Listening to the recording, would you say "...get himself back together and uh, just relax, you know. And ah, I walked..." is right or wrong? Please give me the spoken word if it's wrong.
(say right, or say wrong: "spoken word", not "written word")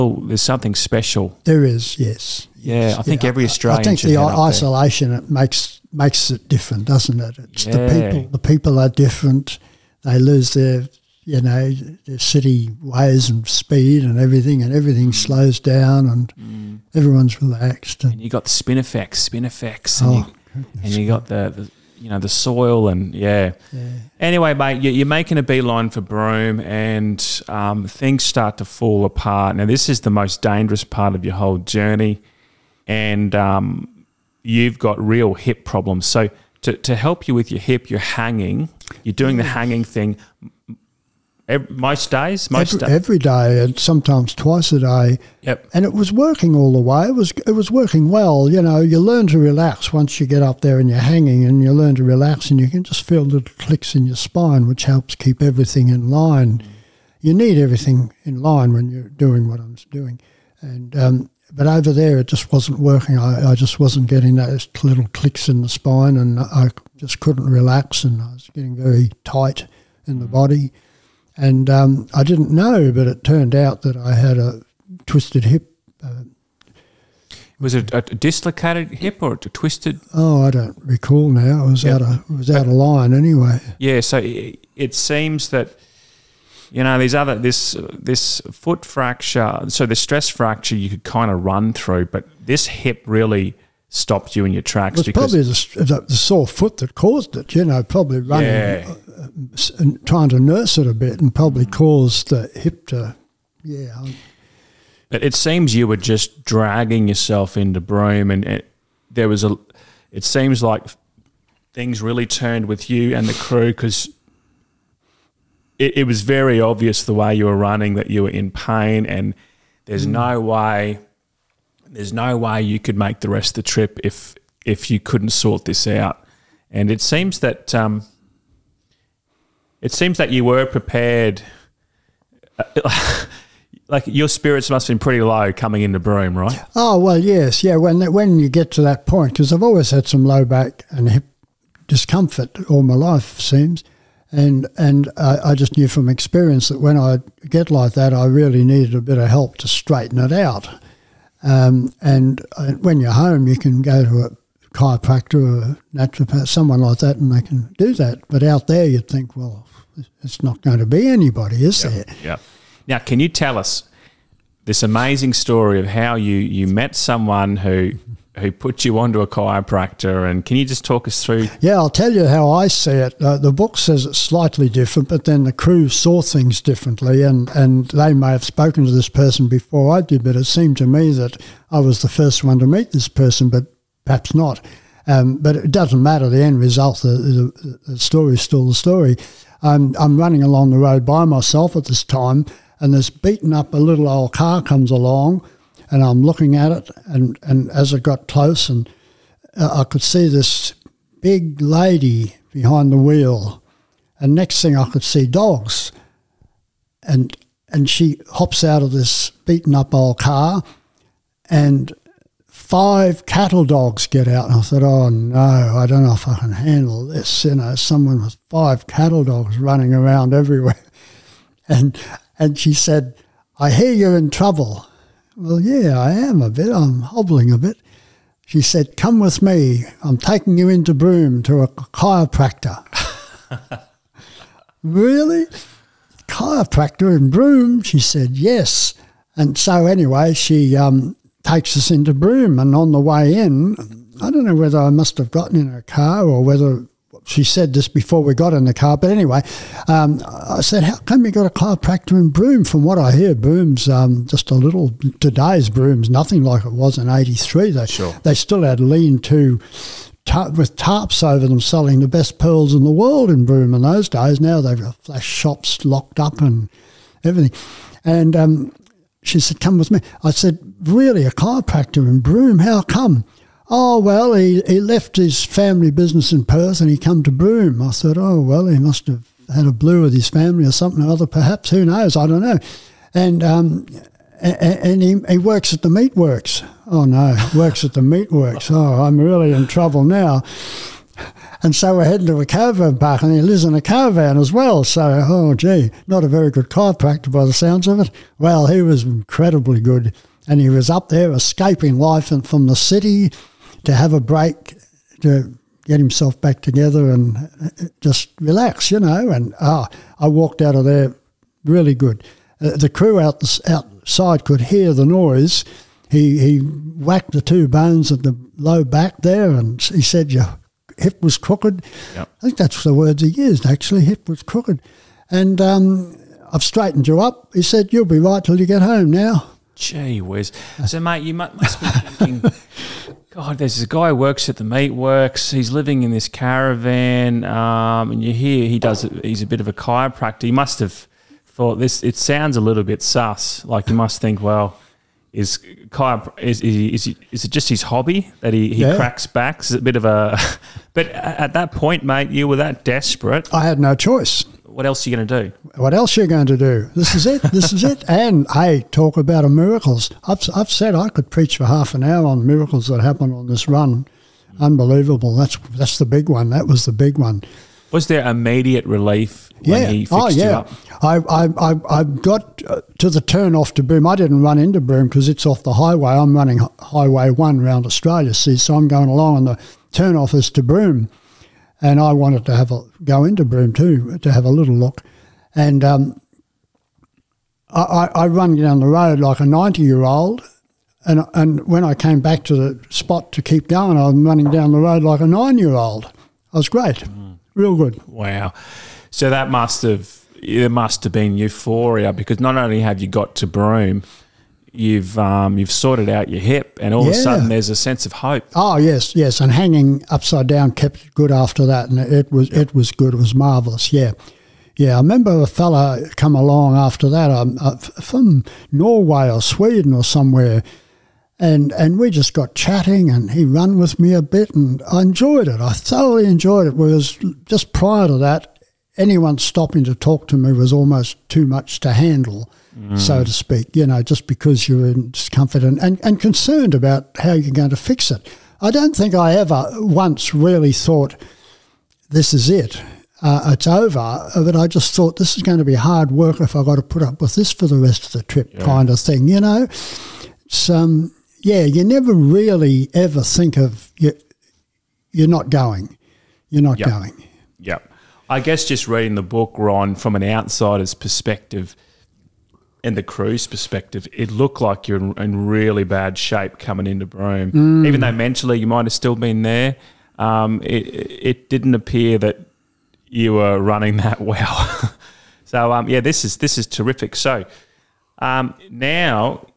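right.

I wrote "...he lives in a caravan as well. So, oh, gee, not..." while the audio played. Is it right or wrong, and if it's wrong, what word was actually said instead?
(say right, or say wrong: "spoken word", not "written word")
right.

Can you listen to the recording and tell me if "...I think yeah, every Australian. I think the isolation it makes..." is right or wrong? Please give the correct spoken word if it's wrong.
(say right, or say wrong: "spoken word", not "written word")
right.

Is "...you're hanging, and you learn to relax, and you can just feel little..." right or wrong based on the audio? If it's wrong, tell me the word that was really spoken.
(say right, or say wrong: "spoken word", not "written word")
right.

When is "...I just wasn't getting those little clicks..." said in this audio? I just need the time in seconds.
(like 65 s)
63 s.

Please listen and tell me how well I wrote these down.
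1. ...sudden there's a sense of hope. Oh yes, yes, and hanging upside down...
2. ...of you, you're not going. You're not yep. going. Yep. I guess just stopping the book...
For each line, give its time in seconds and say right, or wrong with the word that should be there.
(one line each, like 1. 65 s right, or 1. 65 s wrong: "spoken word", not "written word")
1. 407 s right
2. 453 s wrong: "reading", not "stopping".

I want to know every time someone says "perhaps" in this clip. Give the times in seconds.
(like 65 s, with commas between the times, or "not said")
184 s, 281 s.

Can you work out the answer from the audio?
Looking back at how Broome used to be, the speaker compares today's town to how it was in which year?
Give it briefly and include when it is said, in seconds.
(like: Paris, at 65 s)
1983, at 257 s.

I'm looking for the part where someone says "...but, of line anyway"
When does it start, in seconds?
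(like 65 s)
82 s.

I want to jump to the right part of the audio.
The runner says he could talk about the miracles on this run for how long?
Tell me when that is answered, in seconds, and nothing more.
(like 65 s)
361 s.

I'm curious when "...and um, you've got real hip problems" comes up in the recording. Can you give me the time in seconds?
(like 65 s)
32 s.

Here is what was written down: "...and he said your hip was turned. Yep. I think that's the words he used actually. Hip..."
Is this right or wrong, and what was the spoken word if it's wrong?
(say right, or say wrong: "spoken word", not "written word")
wrong: "crooked", not "turned".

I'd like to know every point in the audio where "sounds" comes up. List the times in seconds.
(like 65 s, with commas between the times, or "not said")
297 s, 342 s.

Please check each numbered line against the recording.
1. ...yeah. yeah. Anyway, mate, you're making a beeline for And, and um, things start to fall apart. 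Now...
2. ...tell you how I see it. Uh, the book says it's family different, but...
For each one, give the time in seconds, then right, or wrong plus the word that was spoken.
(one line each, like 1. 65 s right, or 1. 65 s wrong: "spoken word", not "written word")
1. 23 s wrong: "Broome", not "And"
2. 171 s wrong: "slightly", not "family".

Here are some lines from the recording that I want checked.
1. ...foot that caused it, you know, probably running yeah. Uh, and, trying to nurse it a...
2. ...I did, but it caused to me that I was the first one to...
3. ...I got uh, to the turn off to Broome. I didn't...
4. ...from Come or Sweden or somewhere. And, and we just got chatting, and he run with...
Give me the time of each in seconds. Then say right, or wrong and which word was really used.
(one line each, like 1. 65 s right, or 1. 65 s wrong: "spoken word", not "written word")
1. 96 s right
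2. 179 s wrong: "seemed", not "caused"
3. 371 s right
4. 417 s wrong: "Norway", not "Come".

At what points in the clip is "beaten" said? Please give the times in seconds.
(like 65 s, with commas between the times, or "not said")
193 s, 209 s.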